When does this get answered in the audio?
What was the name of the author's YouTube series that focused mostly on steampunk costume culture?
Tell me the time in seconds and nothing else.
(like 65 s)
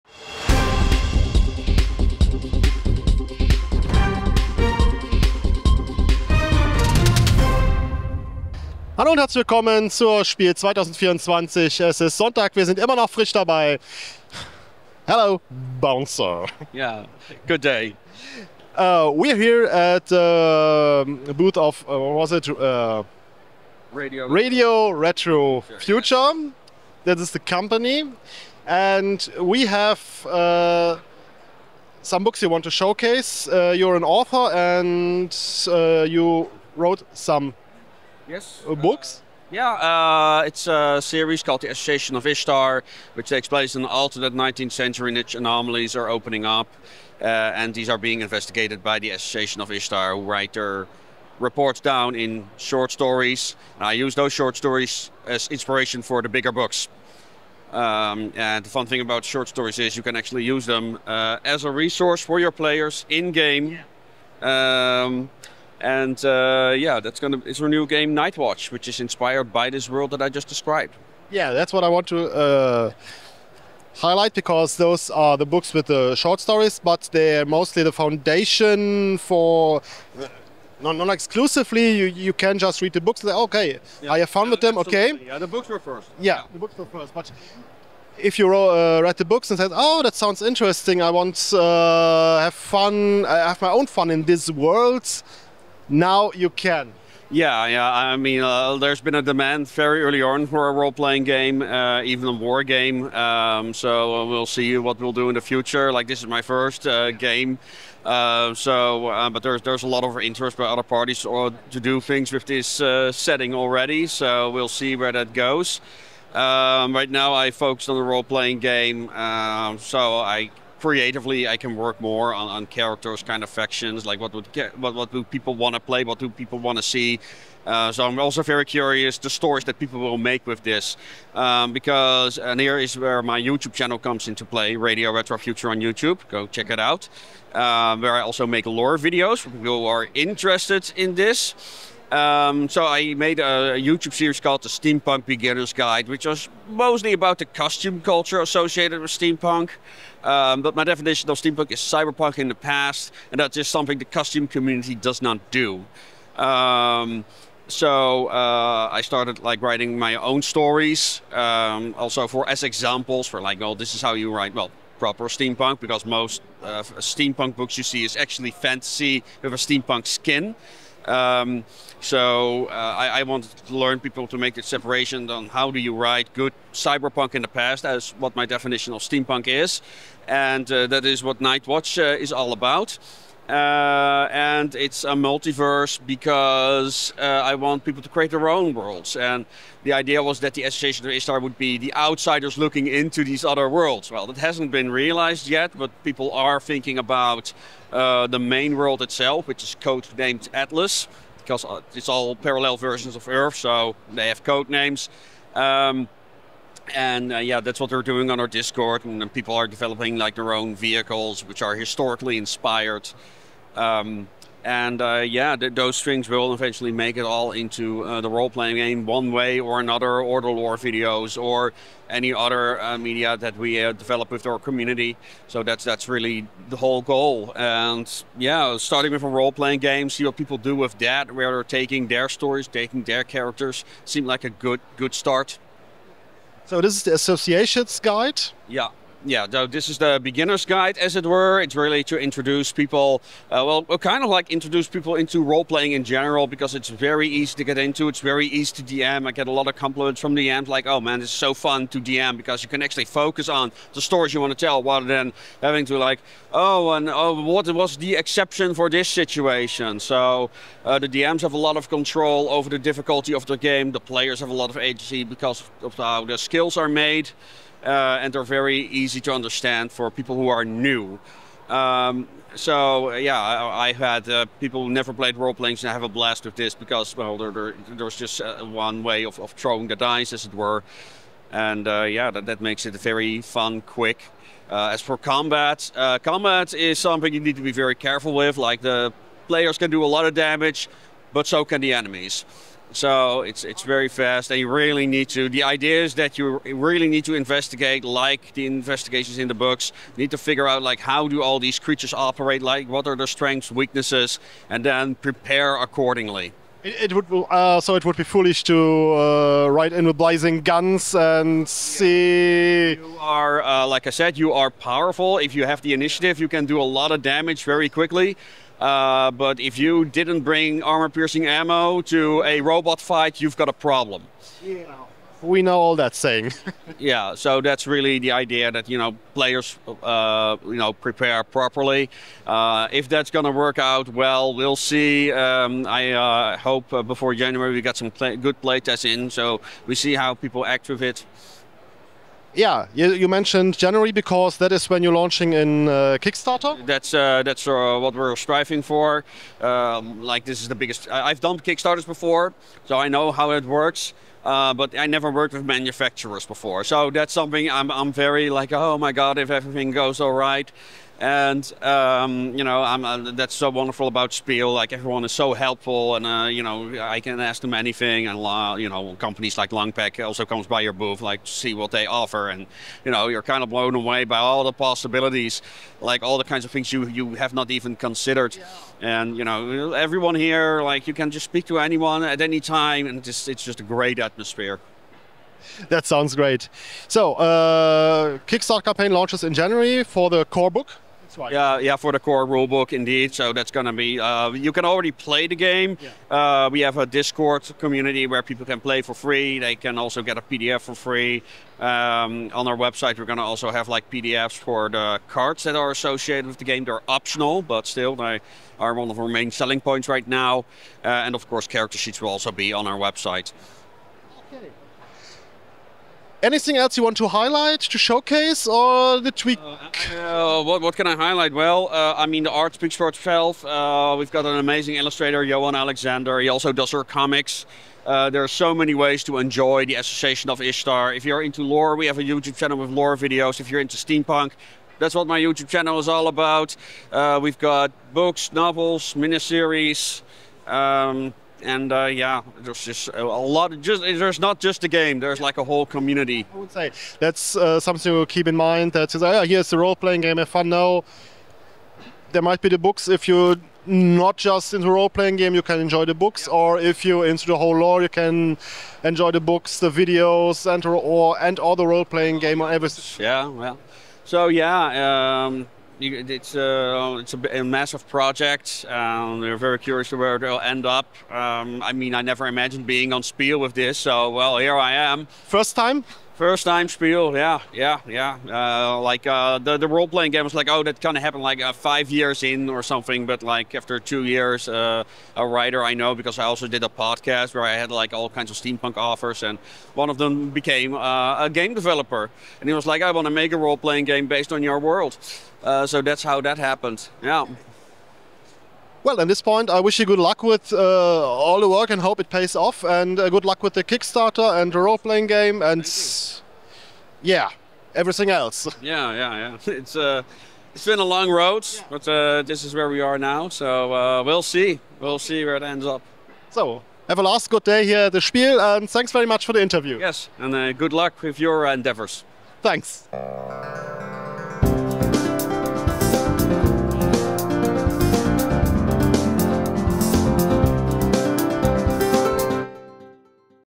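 144 s.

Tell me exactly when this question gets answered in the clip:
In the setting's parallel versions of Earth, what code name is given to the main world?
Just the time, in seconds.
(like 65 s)
200 s.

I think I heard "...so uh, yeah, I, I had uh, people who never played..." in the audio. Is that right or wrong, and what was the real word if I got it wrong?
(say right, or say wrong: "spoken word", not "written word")
right.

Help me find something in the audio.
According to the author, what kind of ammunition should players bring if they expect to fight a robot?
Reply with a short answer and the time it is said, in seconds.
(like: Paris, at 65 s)
Armor-piercing ammo, at 320 s.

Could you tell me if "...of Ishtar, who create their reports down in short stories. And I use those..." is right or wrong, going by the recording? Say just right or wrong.
wrong.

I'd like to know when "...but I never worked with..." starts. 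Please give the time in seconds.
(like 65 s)
354 s.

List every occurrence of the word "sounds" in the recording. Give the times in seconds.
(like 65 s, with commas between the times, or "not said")
90 s, 386 s.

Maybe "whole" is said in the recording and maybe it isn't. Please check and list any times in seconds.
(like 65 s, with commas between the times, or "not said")
226 s, 445 s, 457 s.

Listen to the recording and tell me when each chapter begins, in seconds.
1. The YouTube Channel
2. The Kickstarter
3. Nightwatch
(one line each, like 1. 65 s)
1. 128 s
2. 342 s
3. 39 s.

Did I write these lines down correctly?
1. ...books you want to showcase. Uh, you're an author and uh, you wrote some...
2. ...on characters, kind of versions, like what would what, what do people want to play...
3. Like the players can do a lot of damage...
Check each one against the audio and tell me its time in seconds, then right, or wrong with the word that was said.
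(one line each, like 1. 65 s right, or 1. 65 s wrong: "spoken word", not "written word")
1. 32 s right
2. 122 s wrong: "factions", not "versions"
3. 288 s right.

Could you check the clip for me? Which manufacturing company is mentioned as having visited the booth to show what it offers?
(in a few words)
Longpack.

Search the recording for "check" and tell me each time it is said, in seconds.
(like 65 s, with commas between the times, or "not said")
136 s.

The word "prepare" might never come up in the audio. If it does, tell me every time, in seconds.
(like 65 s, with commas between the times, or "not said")
305 s, 330 s.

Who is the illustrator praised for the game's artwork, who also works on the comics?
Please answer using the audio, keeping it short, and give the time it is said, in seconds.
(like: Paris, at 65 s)
Johan Alexander, at 425 s.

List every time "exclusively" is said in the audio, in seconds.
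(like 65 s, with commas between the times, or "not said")
81 s.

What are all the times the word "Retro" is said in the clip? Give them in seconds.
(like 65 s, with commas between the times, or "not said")
24 s, 135 s.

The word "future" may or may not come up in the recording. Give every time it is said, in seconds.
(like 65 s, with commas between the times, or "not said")
25 s, 105 s, 135 s.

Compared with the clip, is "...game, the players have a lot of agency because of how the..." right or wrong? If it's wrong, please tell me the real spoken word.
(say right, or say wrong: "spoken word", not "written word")
right.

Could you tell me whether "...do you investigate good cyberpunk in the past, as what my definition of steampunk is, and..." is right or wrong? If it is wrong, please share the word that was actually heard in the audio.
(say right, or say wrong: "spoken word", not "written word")
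wrong: "write", not "investigate".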